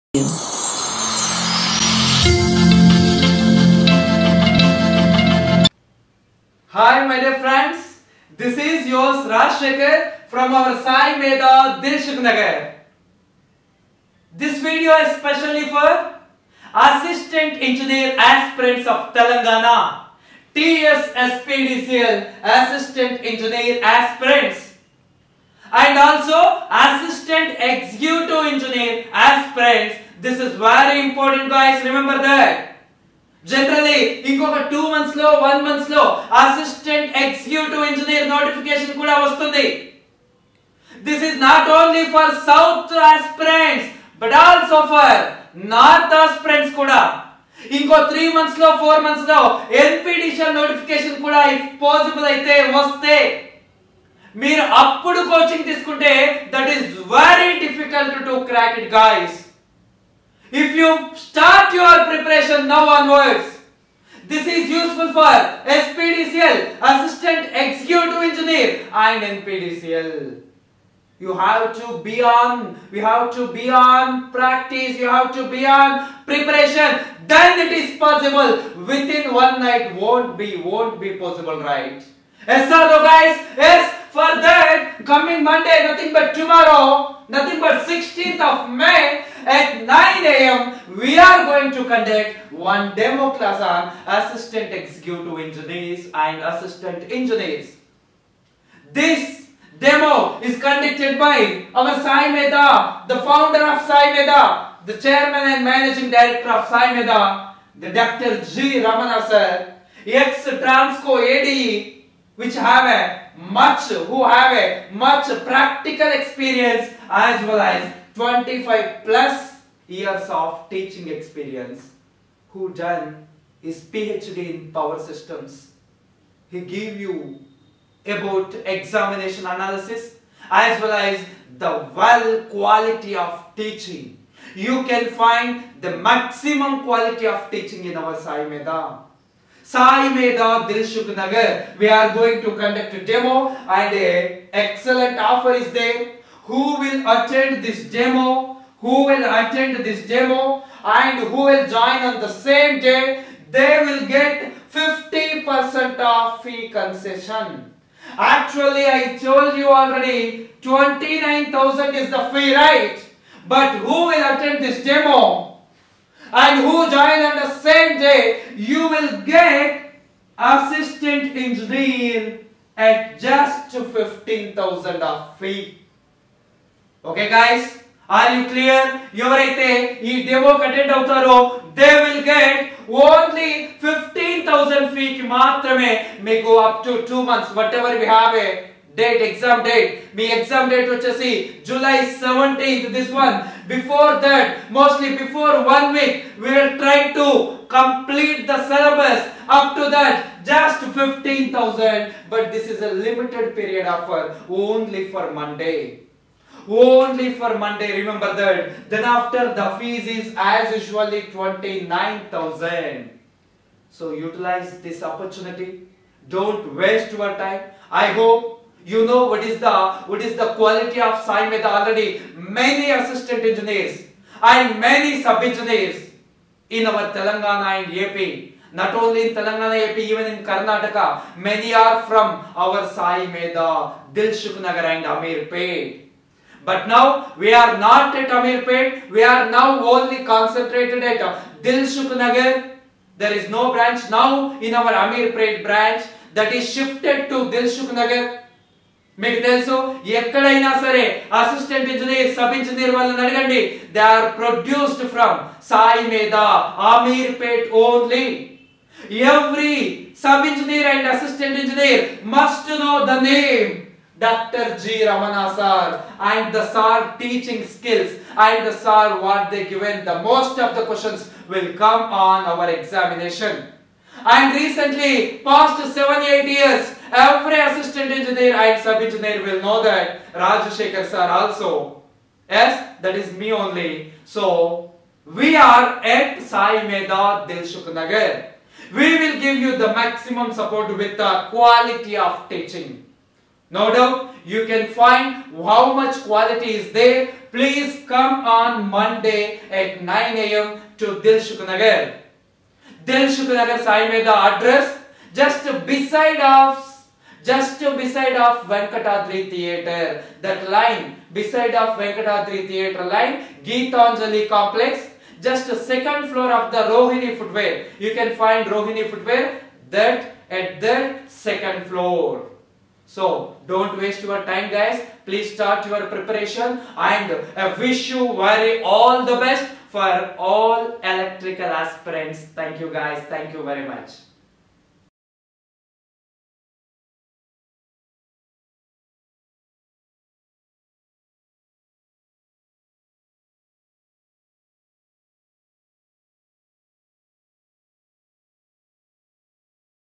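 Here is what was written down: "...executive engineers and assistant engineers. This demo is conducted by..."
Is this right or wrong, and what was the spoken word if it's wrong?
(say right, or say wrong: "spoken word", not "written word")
right.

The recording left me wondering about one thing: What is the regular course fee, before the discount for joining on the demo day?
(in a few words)
29,000.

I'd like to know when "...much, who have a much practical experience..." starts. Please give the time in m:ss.
1:53.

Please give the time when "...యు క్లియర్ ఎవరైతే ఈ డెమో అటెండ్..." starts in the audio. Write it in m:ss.
2:58.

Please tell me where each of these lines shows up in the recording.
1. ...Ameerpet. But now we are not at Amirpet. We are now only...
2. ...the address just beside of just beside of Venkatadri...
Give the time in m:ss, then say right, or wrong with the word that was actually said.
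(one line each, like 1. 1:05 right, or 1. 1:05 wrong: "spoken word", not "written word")
1. 3:55 right
2. 5:04 right.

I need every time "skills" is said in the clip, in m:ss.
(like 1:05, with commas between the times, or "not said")
4:27.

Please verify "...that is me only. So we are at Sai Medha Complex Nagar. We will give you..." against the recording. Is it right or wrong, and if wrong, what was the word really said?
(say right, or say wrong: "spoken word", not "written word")
wrong: "Dilsukh", not "Complex".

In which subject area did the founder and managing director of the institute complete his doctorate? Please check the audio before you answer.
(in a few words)
Power systems.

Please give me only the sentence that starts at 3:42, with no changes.
Many assistant engineers and many sub engineers in our Telangana and AP.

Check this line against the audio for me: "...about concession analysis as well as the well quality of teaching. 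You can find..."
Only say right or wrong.
wrong.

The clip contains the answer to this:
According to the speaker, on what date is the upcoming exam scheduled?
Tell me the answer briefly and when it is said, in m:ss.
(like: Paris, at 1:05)
July 17, at 3:11.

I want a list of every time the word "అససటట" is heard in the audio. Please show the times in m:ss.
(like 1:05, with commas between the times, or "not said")
0:36, 4:11, 4:21.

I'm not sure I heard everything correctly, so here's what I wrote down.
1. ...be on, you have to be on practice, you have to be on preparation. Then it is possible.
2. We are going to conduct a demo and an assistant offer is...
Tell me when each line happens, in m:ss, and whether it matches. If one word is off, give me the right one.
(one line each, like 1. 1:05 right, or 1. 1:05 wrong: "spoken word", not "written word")
1. 1:11 right
2. 2:21 wrong: "excellent", not "assistant".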